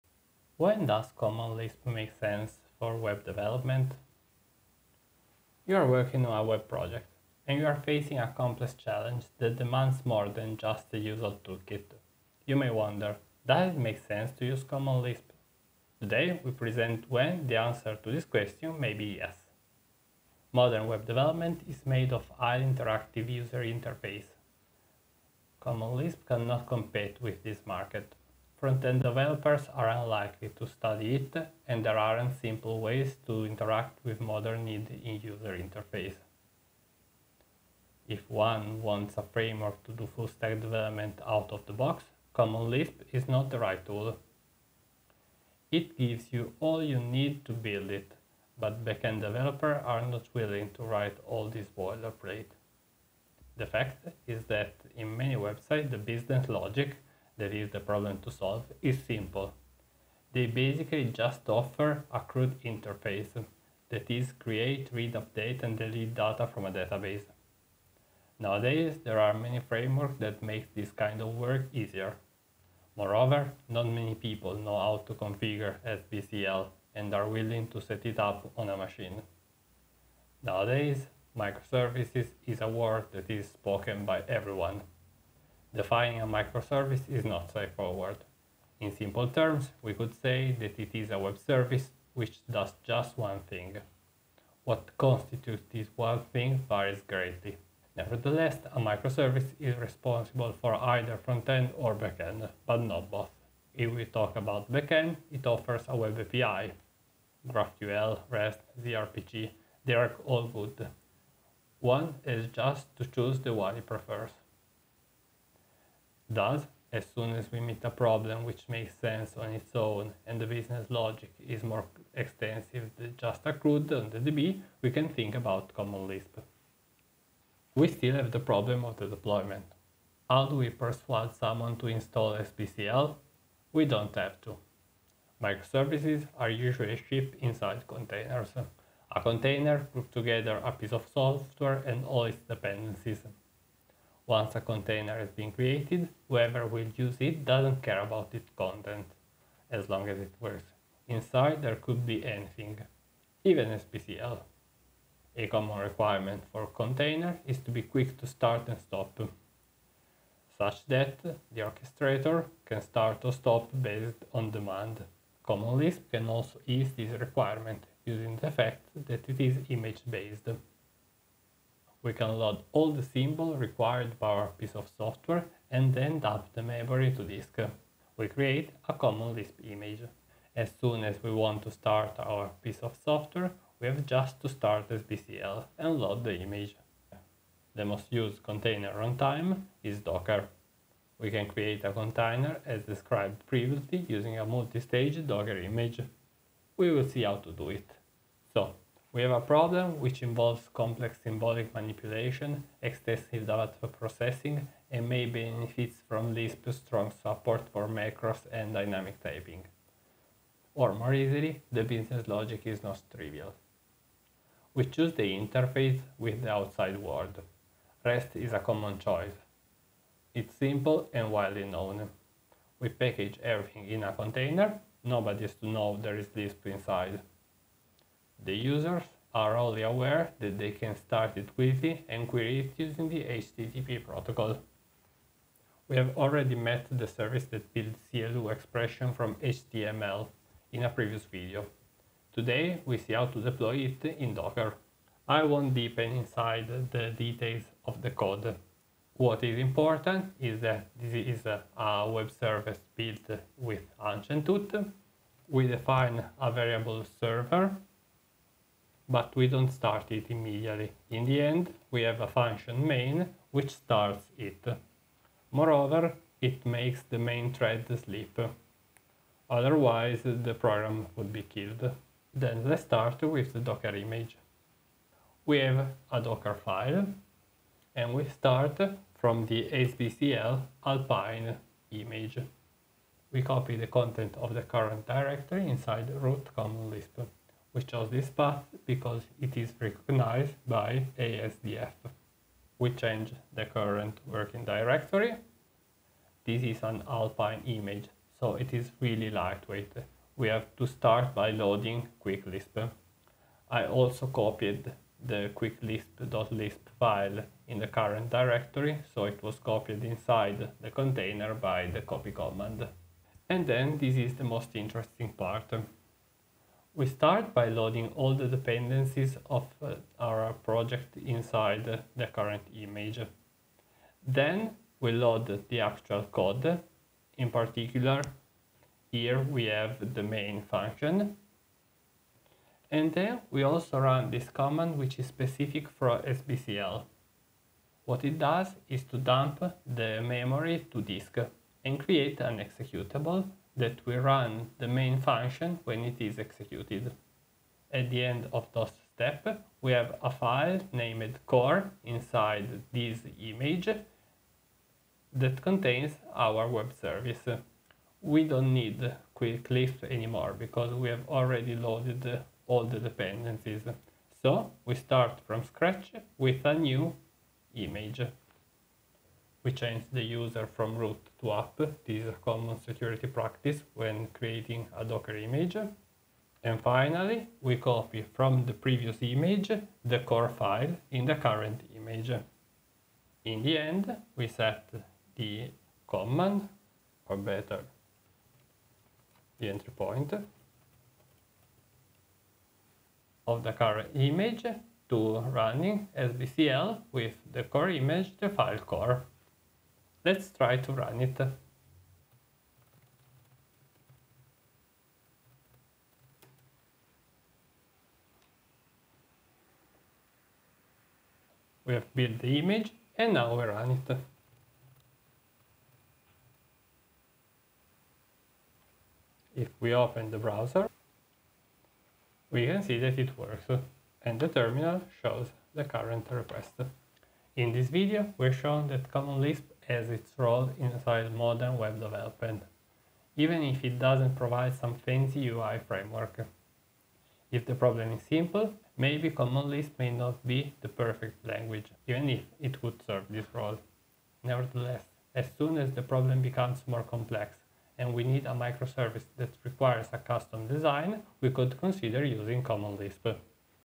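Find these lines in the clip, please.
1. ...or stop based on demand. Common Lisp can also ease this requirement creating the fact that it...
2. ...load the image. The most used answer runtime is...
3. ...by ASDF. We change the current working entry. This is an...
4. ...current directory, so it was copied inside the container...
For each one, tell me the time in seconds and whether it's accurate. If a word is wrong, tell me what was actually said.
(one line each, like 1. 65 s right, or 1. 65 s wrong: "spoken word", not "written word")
1. 163 s wrong: "using", not "creating"
2. 185 s wrong: "container", not "answer"
3. 290 s wrong: "directory", not "entry"
4. 307 s right.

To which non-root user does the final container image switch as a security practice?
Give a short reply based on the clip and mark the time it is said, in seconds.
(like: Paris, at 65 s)
app, at 371 s.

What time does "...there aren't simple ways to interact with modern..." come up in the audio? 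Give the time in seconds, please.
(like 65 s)
31 s.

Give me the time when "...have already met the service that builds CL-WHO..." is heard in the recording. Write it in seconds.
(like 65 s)
235 s.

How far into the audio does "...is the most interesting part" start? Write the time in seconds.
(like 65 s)
314 s.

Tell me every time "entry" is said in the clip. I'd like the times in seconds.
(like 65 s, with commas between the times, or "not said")
389 s.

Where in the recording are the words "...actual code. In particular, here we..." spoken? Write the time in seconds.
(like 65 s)
325 s.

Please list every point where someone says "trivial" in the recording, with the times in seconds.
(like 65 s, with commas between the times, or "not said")
213 s.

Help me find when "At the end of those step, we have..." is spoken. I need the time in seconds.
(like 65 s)
347 s.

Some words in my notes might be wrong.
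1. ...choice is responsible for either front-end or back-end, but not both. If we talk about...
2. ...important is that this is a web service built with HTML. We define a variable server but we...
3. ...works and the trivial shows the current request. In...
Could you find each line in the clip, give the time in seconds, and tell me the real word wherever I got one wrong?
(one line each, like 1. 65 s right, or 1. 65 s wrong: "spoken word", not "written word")
1. 98 s wrong: "microservice", not "choice"
2. 249 s wrong: "Hunchentoot", not "HTML"
3. 423 s wrong: "terminal", not "trivial".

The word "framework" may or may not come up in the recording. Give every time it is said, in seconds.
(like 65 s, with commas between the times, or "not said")
39 s, 69 s, 435 s.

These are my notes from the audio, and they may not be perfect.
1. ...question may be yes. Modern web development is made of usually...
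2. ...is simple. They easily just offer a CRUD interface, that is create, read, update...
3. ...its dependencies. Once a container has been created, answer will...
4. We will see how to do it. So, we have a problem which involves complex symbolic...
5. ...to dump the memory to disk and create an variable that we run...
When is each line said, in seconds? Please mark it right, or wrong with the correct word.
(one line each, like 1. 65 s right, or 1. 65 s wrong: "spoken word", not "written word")
1. 18 s wrong: "highly", not "usually"
2. 58 s wrong: "basically", not "easily"
3. 142 s wrong: "whoever", not "answer"
4. 196 s right
5. 339 s wrong: "executable", not "variable".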